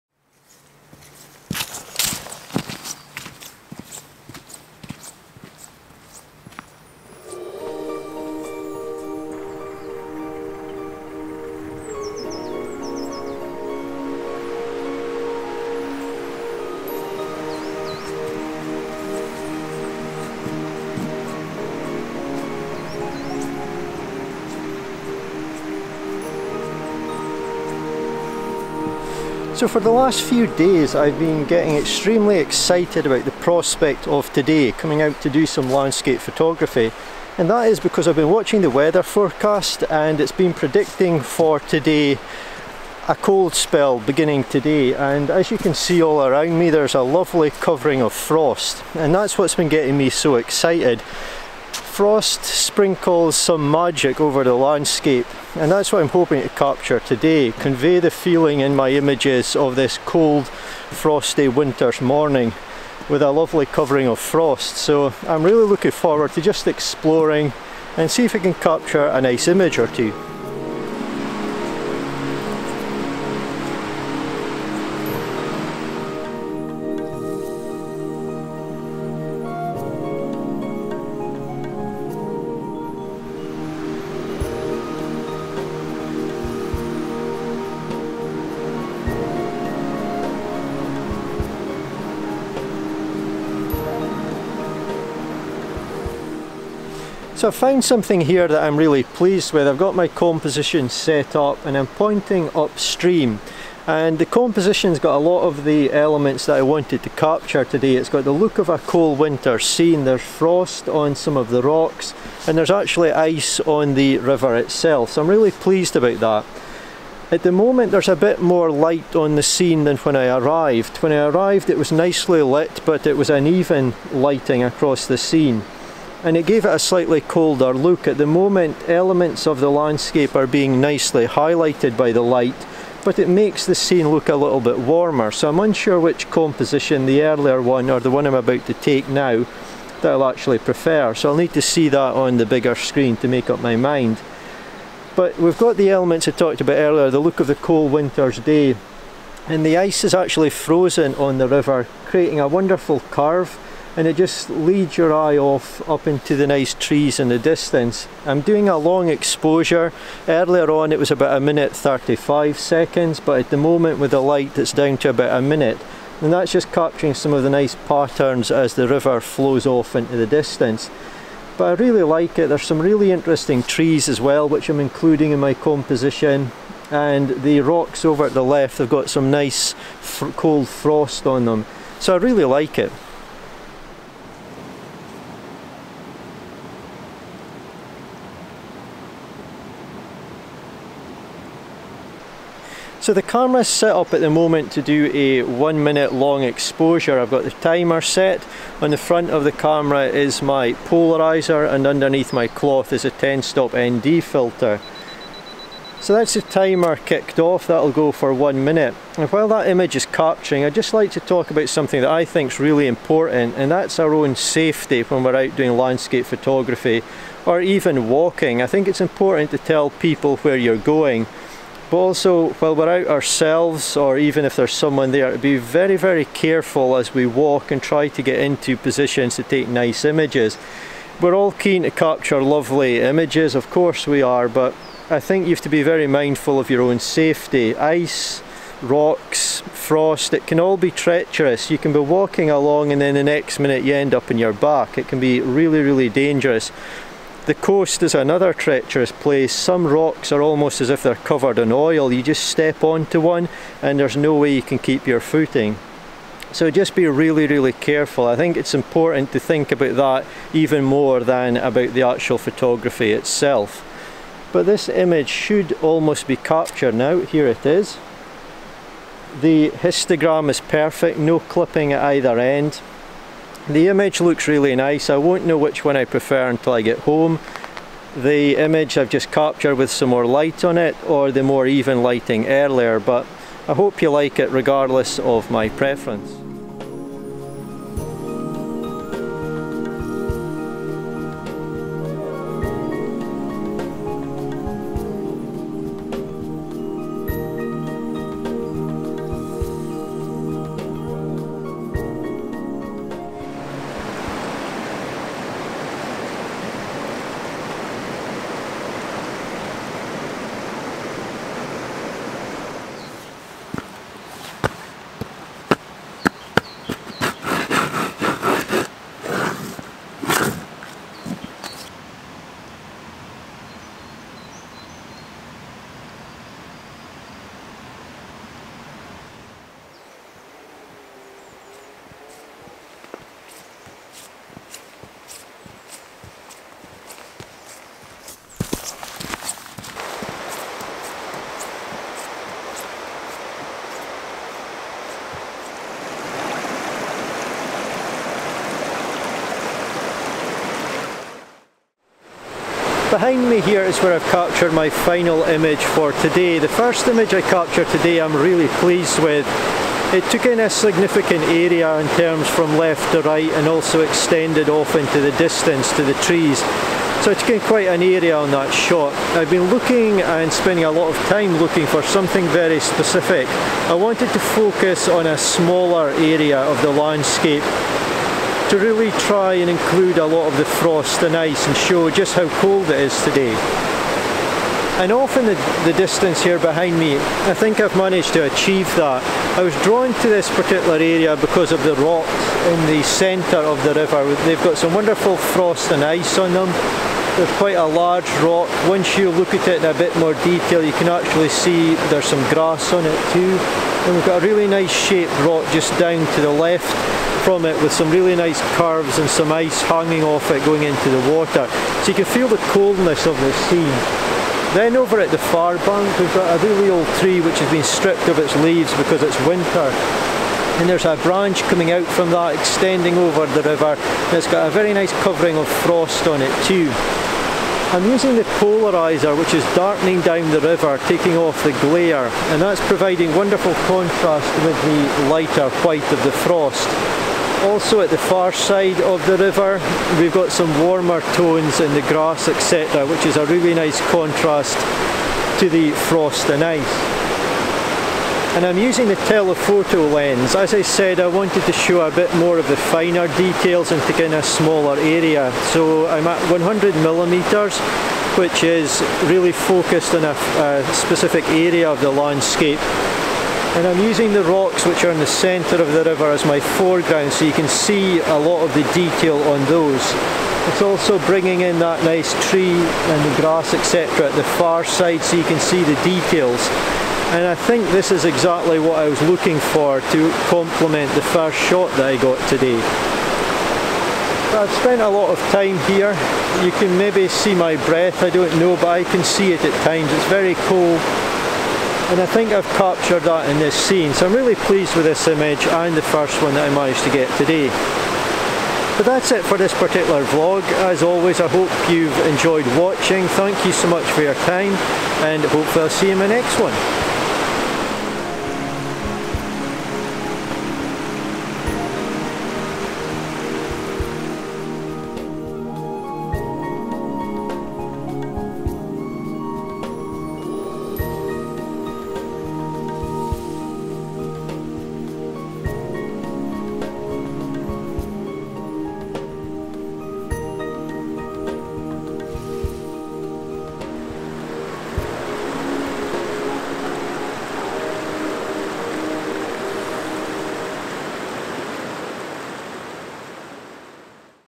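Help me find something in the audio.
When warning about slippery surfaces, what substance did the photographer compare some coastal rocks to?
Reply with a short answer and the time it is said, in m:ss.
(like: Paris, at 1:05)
Oil, at 4:11.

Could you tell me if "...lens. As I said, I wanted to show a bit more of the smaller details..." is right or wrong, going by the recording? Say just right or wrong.
wrong.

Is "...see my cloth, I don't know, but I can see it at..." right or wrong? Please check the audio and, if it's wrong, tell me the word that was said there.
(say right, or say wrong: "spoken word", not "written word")
wrong: "breath", not "cloth".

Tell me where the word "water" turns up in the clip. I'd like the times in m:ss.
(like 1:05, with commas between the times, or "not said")
6:51.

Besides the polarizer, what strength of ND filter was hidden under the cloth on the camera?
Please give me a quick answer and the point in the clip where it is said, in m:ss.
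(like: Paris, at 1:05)
10 stop, at 3:23.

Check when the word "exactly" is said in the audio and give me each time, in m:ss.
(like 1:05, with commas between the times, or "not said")
7:58.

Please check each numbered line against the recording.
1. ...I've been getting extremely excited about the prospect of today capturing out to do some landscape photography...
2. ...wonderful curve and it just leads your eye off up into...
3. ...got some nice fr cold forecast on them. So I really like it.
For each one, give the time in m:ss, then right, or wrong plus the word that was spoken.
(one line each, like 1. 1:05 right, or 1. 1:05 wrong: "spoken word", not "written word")
1. 0:30 wrong: "coming", not "capturing"
2. 2:32 right
3. 2:58 wrong: "frost", not "forecast".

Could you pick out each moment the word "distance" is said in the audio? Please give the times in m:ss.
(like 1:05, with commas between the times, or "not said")
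2:37, 2:50, 6:05, 6:25.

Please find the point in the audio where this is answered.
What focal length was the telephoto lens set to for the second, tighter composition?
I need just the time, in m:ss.
7:36.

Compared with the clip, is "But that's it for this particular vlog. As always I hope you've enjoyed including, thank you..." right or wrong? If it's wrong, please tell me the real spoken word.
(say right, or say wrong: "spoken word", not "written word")
wrong: "watching", not "including".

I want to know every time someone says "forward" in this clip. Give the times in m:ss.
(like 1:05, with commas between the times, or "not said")
1:05.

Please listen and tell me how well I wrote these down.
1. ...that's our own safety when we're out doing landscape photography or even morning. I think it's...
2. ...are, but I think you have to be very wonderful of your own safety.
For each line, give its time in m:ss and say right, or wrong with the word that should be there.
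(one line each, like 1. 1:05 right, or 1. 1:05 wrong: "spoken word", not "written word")
1. 3:33 wrong: "walking", not "morning"
2. 3:54 wrong: "mindful", not "wonderful".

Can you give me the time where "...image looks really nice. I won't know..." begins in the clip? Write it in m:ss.
4:33.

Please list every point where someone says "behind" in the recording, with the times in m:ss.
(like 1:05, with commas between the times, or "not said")
5:53, 6:26.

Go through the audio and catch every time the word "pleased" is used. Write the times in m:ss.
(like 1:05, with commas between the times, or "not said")
1:39, 1:55, 5:58, 8:14.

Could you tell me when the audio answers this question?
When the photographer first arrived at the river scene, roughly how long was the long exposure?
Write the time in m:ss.
2:41.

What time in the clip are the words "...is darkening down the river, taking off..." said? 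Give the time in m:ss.
7:09.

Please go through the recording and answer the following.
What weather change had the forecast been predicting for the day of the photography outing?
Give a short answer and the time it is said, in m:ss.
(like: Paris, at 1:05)
A cold spell, at 0:43.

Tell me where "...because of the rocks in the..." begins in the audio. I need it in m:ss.
6:31.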